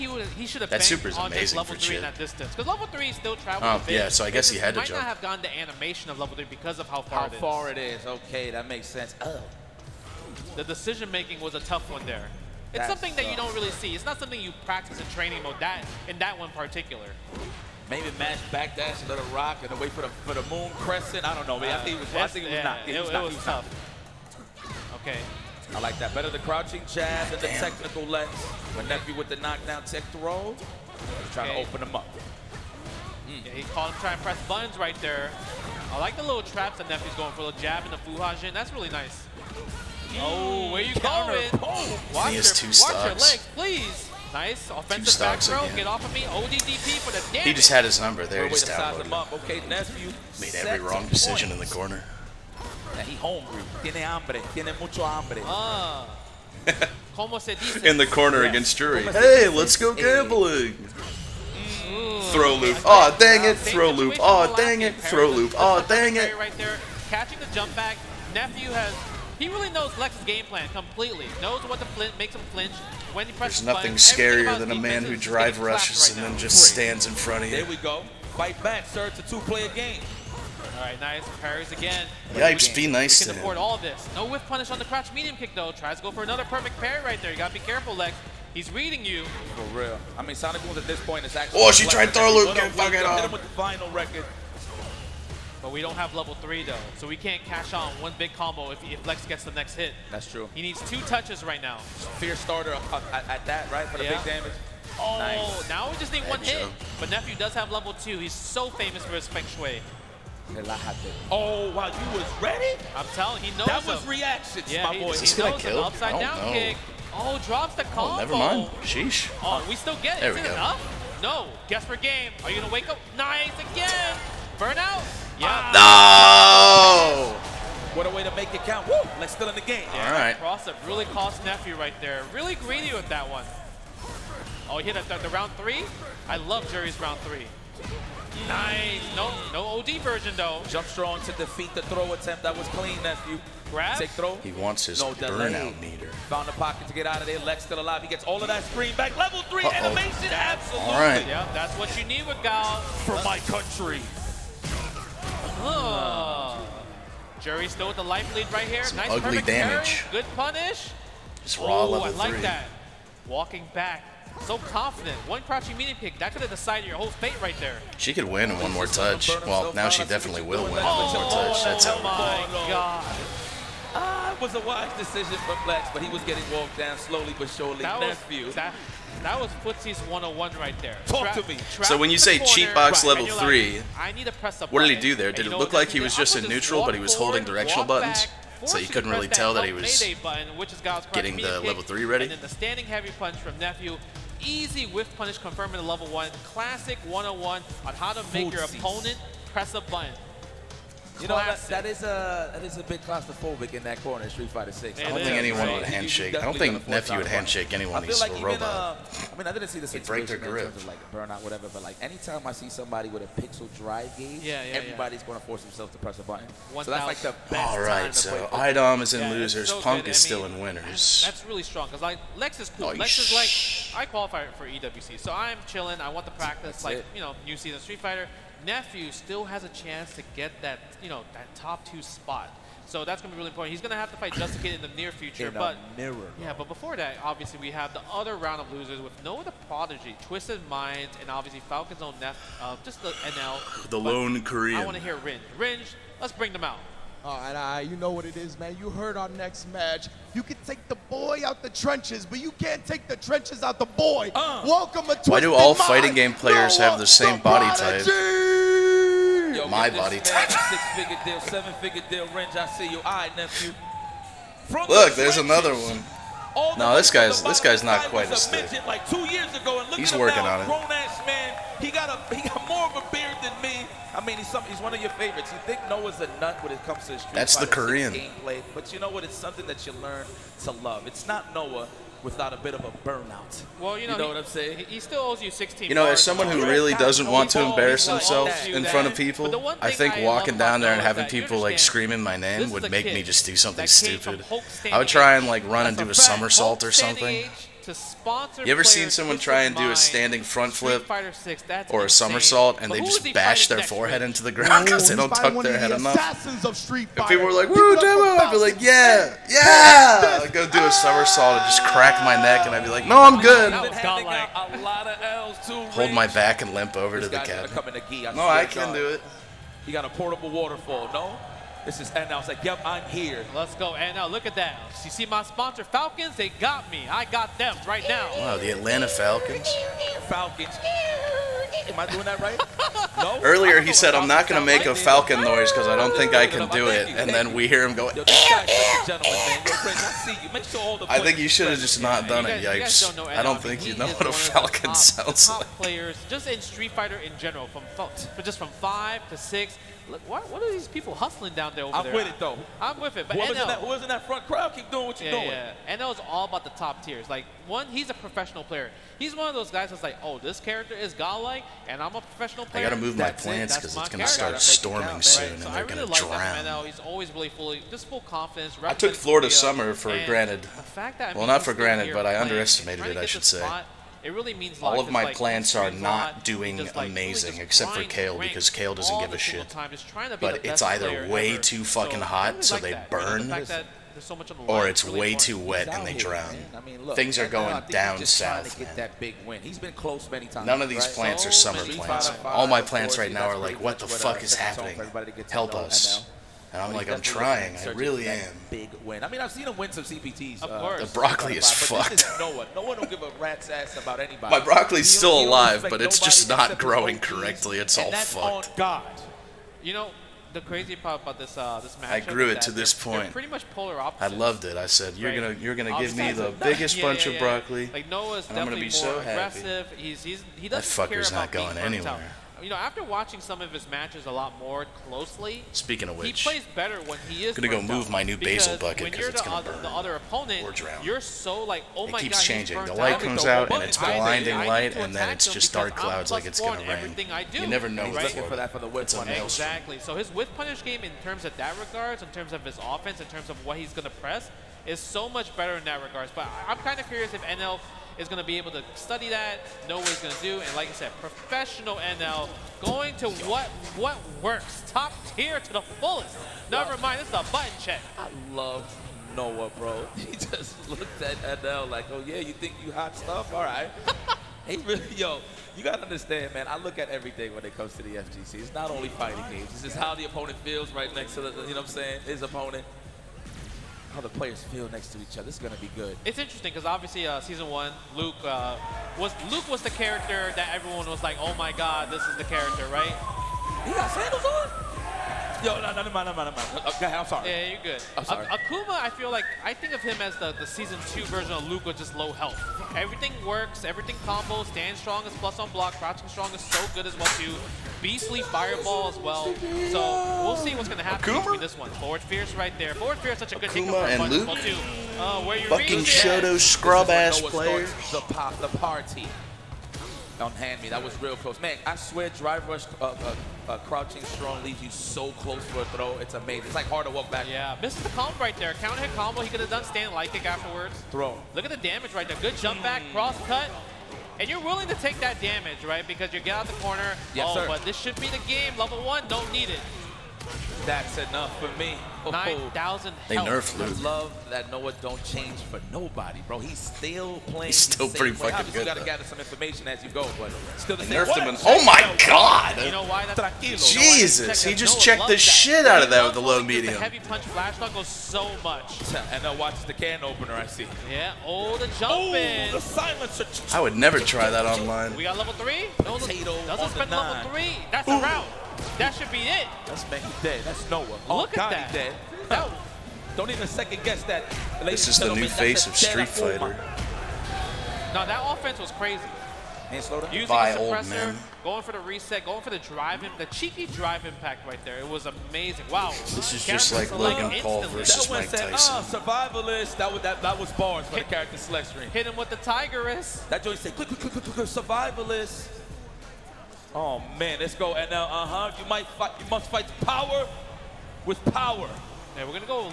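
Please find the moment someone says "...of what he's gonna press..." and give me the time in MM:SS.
07:23.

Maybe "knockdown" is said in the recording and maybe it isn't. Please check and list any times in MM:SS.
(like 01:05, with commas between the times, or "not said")
00:29.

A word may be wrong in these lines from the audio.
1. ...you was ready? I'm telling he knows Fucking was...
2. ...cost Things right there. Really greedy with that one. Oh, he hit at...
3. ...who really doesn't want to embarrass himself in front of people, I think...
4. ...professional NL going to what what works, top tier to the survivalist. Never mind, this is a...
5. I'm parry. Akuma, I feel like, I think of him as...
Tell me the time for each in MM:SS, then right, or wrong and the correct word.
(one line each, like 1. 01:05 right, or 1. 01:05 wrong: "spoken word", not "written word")
1. 01:51 wrong: "That", not "Fucking"
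2. 02:11 wrong: "Nephew", not "Things"
3. 04:46 right
4. 07:31 wrong: "fullest", not "survivalist"
5. 08:08 wrong: "sorry", not "parry".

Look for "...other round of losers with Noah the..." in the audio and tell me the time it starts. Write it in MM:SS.
03:58.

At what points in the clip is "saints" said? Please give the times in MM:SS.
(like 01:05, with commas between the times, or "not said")
not said.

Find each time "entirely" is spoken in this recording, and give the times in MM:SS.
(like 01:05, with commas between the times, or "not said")
not said.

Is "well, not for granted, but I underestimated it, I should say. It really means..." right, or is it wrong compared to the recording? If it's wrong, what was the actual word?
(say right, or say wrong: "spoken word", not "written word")
right.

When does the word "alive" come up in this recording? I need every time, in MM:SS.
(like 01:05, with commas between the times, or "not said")
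02:27, 06:45.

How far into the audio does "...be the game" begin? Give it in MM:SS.
08:48.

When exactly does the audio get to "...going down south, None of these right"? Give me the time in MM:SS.
06:27.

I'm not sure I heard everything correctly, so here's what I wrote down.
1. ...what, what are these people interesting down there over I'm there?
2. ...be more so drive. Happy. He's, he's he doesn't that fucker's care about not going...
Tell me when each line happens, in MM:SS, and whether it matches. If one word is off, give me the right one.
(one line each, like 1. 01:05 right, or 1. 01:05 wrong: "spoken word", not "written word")
1. 05:50 wrong: "hustling", not "interesting"
2. 06:58 wrong: "aggressive", not "drive".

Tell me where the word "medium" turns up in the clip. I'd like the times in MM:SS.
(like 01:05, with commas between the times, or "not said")
01:25, 09:06.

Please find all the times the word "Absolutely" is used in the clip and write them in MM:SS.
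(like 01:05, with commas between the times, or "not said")
02:30.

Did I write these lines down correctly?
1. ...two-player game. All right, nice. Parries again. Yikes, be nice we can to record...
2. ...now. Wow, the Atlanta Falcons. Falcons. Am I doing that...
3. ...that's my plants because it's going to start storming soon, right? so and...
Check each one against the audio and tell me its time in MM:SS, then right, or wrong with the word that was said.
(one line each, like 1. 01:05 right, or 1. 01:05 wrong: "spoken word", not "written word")
1. 01:19 wrong: "afford", not "record"
2. 05:28 right
3. 06:03 right.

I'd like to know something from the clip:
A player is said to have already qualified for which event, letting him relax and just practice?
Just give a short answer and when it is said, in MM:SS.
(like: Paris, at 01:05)
EWC, at 03:44.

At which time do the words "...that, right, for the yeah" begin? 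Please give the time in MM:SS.
01:43.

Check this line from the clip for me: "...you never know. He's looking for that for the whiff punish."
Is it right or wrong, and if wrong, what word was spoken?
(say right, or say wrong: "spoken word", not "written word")
right.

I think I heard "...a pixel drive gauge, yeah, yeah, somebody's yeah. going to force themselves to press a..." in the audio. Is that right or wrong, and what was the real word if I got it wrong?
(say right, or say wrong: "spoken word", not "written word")
wrong: "everybody", not "somebody".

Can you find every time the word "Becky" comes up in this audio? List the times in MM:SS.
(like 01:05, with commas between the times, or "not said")
09:20.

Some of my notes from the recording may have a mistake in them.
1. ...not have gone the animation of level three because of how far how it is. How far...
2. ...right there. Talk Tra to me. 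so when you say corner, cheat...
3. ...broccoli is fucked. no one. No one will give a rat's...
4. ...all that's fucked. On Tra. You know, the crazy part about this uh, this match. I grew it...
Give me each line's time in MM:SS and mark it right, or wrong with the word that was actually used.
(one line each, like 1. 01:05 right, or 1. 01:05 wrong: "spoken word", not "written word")
1. 00:04 right
2. 03:00 right
3. 06:41 right
4. 06:47 wrong: "God", not "Tra".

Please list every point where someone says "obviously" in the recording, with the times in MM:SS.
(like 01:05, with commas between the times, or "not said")
03:57, 04:01, 07:56.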